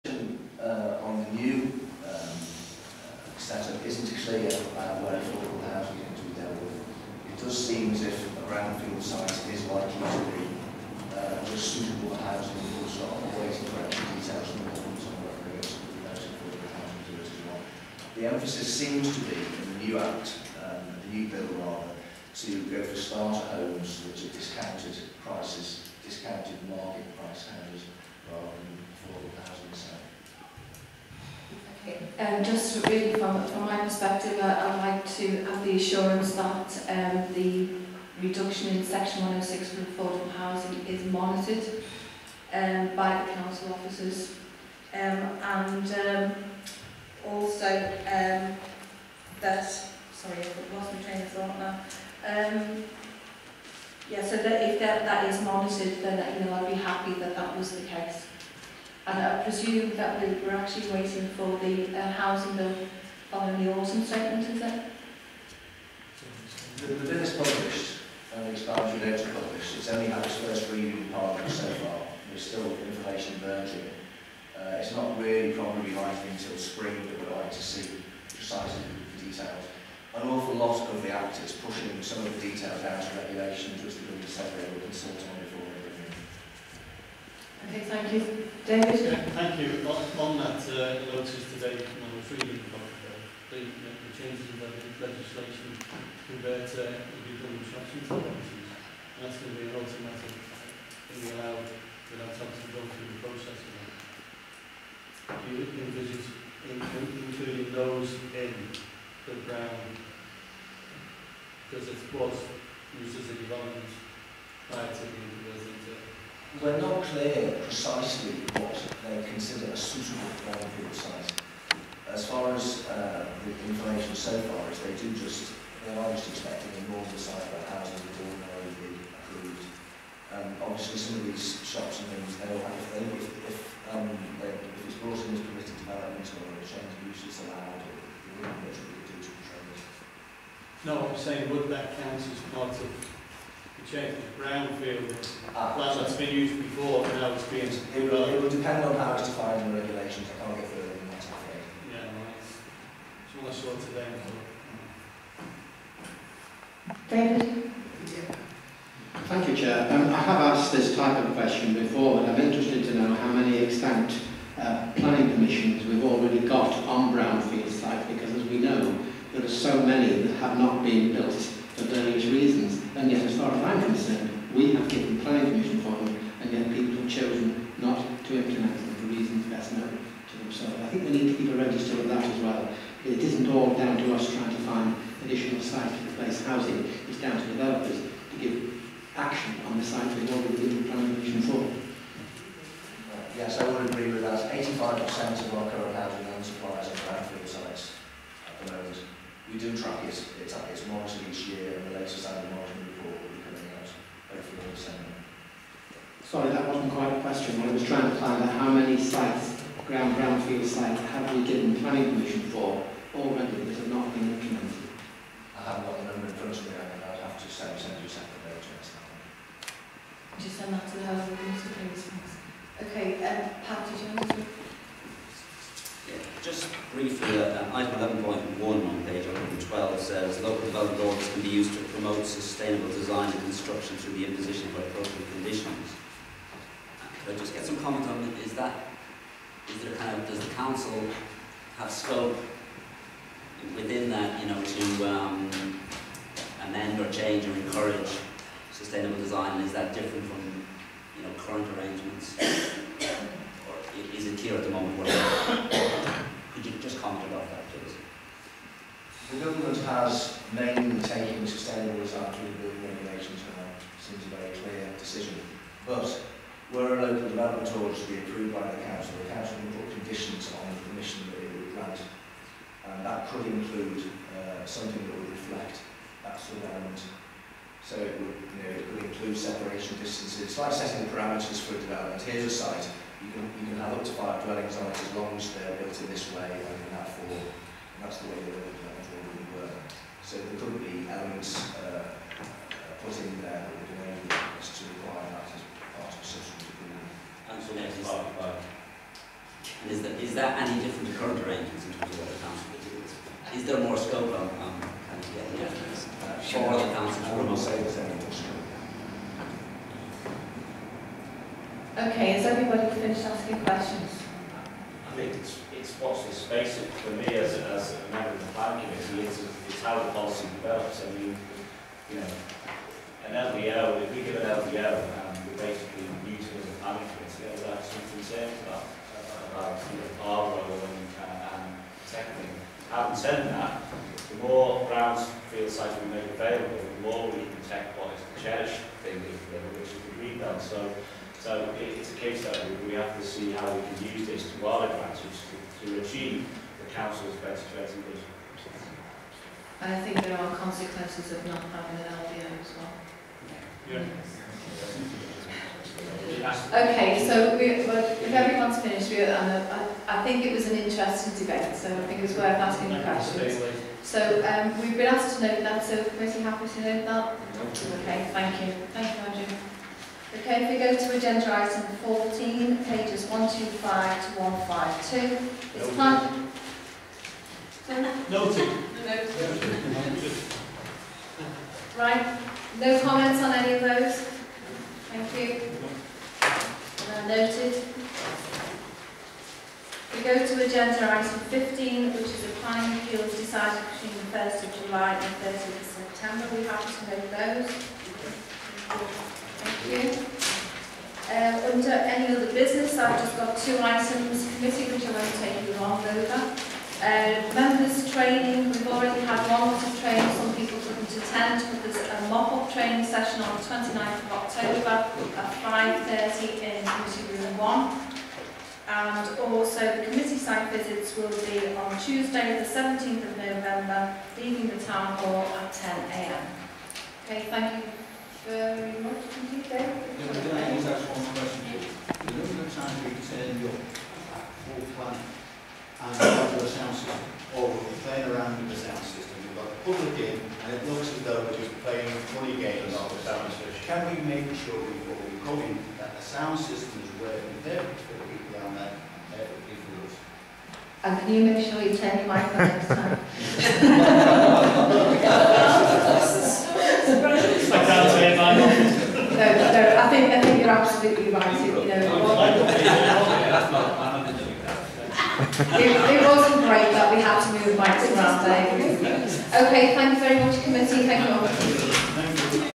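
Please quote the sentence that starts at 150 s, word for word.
I can't get further than that, I'm afraid.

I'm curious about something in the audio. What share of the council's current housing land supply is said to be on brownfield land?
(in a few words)
85%.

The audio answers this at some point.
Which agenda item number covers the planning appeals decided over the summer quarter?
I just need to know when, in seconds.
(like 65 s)
391 s.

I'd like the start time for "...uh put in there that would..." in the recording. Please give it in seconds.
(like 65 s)
292 s.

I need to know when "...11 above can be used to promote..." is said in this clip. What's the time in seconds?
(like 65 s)
227 s.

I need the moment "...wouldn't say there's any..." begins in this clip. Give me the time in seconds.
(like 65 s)
307 s.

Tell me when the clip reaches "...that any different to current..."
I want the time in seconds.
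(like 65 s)
300 s.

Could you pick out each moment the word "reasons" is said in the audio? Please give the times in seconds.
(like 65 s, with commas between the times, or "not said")
172 s, 179 s.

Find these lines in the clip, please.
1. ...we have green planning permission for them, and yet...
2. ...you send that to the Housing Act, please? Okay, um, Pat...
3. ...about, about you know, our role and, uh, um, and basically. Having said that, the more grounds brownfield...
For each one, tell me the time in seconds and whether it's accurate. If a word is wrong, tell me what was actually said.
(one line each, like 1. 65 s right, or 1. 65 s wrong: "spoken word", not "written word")
1. 174 s wrong: "given", not "green"
2. 220 s wrong: "Minister", not "Act"
3. 328 s wrong: "technically", not "basically".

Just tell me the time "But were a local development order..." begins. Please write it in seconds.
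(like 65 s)
265 s.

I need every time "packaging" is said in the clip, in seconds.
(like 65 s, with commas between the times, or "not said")
not said.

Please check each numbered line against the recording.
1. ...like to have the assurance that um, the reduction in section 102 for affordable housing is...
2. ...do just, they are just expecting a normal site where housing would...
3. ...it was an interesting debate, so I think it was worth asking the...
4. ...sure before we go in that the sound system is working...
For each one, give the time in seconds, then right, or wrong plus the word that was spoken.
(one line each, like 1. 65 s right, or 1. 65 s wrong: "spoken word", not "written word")
1. 34 s wrong: "106", not "102"
2. 124 s right
3. 360 s right
4. 444 s right.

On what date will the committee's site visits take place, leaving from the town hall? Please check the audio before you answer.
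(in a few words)
17 November.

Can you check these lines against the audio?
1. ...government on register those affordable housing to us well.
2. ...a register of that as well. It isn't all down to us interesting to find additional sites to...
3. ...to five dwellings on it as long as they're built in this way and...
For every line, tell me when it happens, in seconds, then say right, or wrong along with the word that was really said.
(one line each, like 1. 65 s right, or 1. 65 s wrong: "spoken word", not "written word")
1. 14 s wrong: "whether", not "register"
2. 181 s wrong: "trying", not "interesting"
3. 284 s right.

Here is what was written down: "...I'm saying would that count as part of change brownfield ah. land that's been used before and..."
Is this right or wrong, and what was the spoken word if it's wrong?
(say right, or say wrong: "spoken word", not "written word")
right.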